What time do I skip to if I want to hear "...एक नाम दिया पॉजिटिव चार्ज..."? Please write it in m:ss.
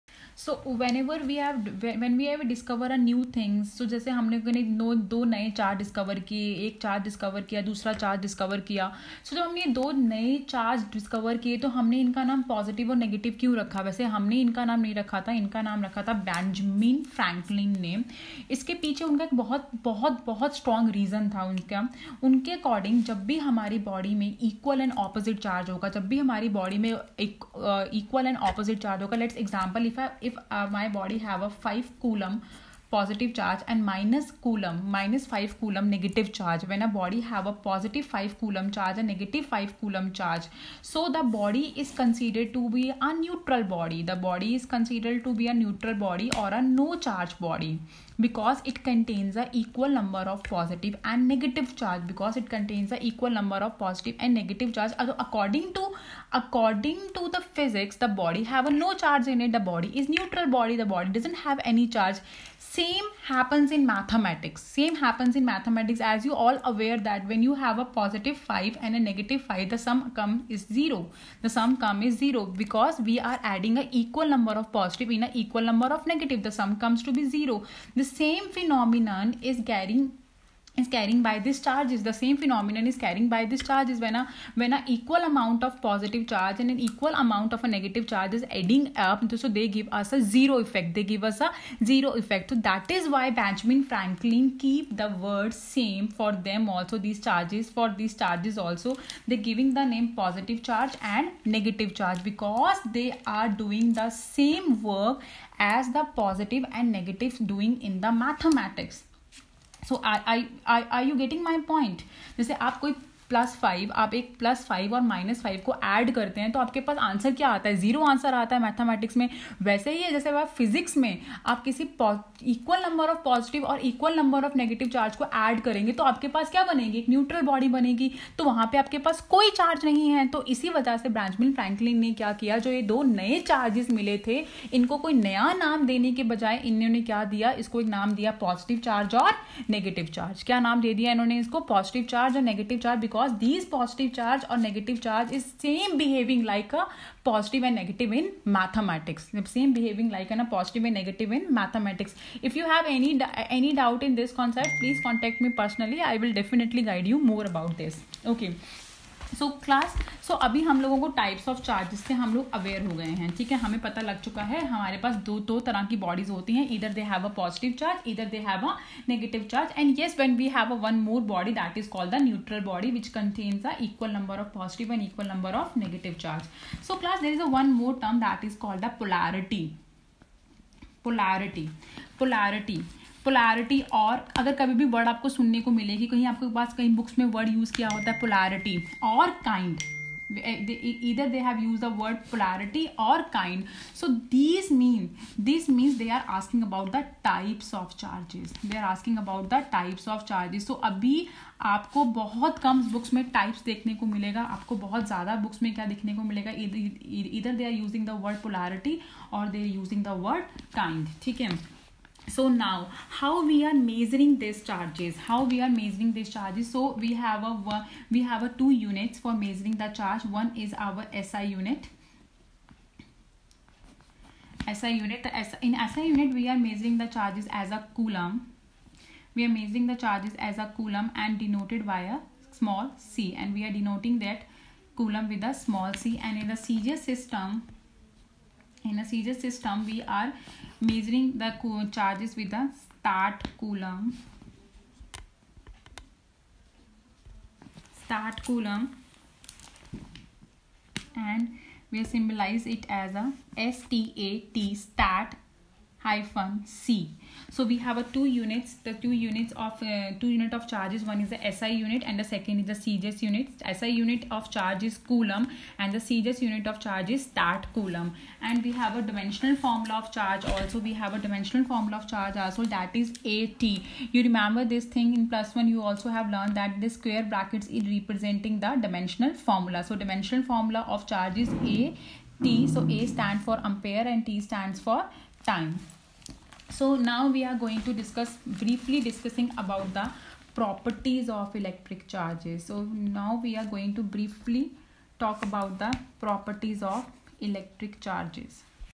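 2:17.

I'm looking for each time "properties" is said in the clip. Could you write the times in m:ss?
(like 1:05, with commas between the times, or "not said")
4:50, 4:56.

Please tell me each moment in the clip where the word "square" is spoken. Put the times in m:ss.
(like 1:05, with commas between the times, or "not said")
4:36.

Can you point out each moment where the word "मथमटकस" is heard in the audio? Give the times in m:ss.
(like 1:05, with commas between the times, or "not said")
1:58.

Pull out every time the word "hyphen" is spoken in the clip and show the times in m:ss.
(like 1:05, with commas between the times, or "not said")
4:16.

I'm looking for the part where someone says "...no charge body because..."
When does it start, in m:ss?
0:46.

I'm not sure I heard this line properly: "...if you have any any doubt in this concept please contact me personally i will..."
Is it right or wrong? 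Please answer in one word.
right.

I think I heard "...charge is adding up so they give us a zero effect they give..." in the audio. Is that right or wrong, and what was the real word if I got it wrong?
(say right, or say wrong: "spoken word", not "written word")
right.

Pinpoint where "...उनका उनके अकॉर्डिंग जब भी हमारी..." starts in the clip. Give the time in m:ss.
0:21.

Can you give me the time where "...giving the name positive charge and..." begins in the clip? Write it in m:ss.
1:39.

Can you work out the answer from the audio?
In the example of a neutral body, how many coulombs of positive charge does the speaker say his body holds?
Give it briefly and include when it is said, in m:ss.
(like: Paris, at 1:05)
5 coulomb, at 0:31.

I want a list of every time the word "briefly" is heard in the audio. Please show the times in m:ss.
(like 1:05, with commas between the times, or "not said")
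4:48, 4:54.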